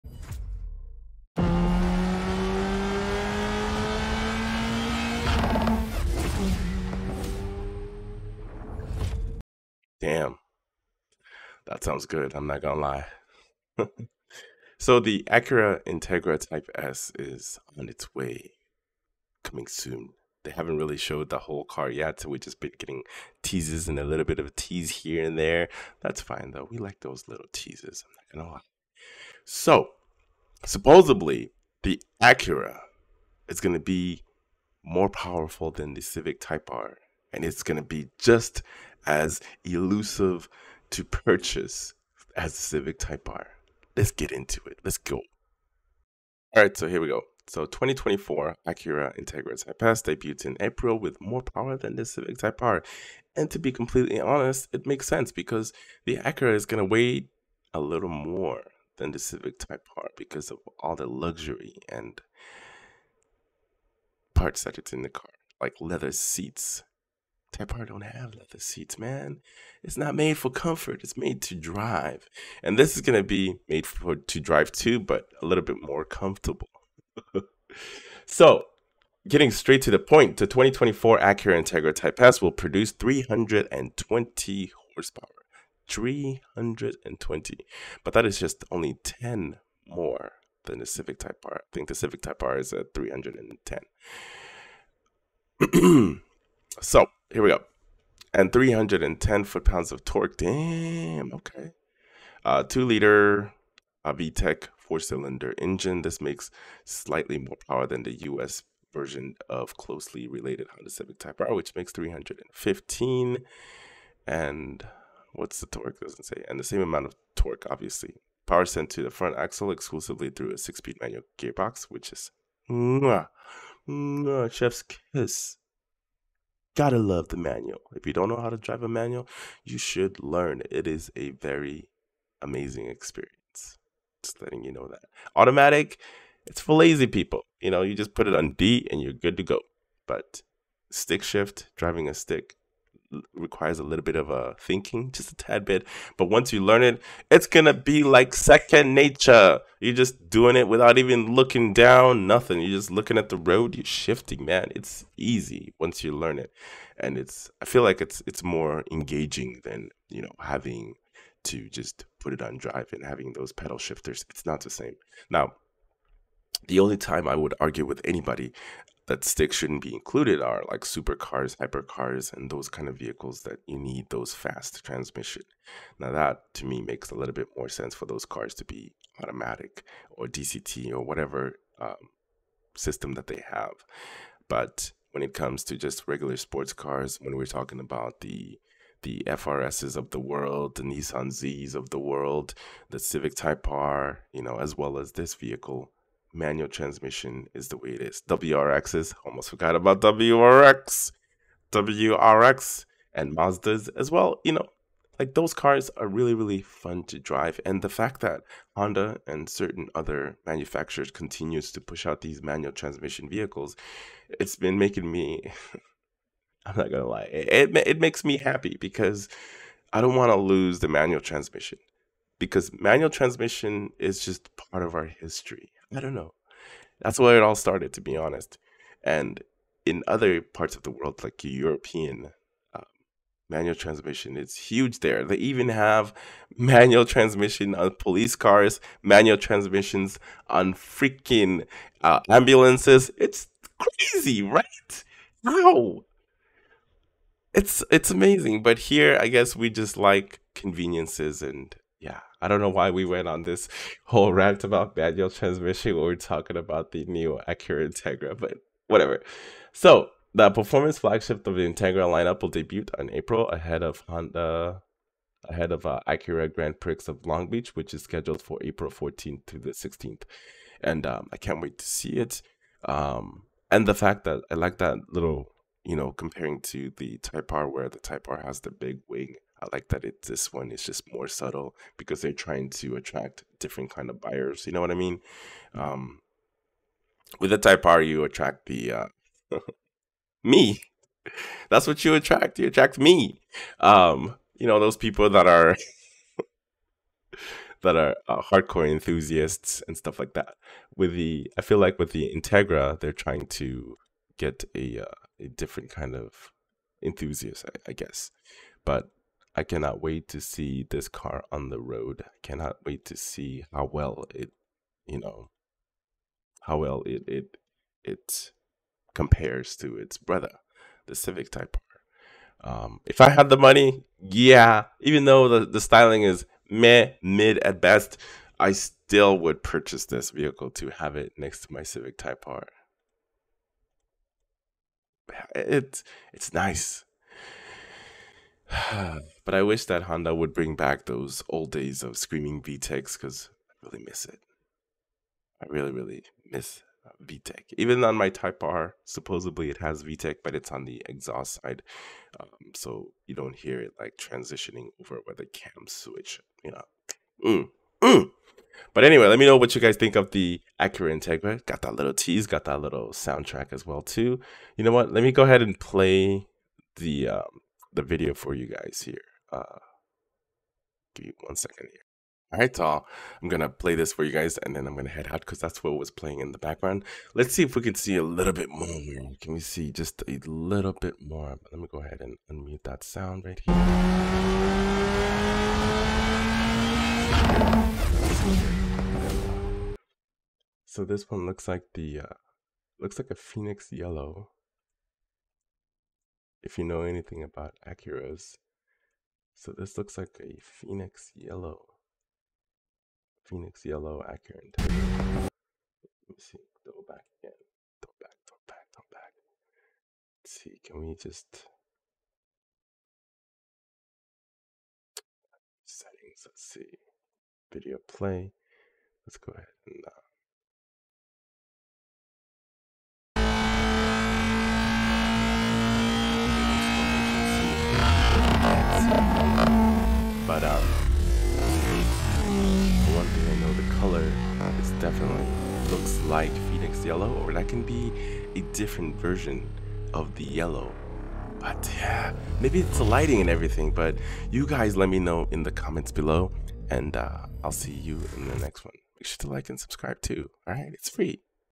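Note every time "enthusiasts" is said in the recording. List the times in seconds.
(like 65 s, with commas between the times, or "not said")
298 s, 307 s.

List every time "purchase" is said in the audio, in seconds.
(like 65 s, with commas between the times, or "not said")
41 s, 329 s.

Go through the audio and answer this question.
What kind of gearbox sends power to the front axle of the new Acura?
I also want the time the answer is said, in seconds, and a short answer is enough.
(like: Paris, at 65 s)
six speed manual, at 120 s.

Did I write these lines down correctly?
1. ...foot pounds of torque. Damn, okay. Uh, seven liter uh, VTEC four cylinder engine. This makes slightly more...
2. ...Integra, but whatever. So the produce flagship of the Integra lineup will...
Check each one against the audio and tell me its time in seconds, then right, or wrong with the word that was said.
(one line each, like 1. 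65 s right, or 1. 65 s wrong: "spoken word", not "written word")
1. 99 s wrong: "two", not "seven"
2. 257 s wrong: "performance", not "produce".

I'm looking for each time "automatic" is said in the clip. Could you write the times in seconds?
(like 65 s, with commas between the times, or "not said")
135 s, 179 s.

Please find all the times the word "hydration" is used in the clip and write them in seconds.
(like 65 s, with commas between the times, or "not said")
not said.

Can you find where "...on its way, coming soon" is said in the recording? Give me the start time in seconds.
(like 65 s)
17 s.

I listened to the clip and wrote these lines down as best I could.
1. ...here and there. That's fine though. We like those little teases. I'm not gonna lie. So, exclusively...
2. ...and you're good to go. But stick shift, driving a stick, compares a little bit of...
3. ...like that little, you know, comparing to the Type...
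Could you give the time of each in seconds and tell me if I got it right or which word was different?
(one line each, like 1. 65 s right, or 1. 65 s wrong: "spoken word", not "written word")
1. 24 s wrong: "supposedly", not "exclusively"
2. 138 s wrong: "requires", not "compares"
3. 274 s right.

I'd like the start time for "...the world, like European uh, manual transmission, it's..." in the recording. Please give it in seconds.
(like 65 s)
230 s.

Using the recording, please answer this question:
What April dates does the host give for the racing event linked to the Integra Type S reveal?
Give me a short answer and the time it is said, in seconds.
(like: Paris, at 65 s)
April 14-16, at 268 s.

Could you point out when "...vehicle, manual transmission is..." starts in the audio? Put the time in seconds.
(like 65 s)
195 s.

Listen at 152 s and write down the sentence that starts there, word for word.
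You're just looking at the road.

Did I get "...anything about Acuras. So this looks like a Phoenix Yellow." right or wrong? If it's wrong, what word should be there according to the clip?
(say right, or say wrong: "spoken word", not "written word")
right.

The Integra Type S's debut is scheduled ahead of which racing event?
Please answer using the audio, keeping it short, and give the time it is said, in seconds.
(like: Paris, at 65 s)
Acura Grand Prix of Long Beach, at 266 s.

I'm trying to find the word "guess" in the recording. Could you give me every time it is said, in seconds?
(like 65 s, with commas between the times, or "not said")
249 s, 307 s.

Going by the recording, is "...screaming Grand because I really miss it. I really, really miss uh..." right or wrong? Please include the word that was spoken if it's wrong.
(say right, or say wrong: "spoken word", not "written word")
wrong: "VTECs", not "Grand".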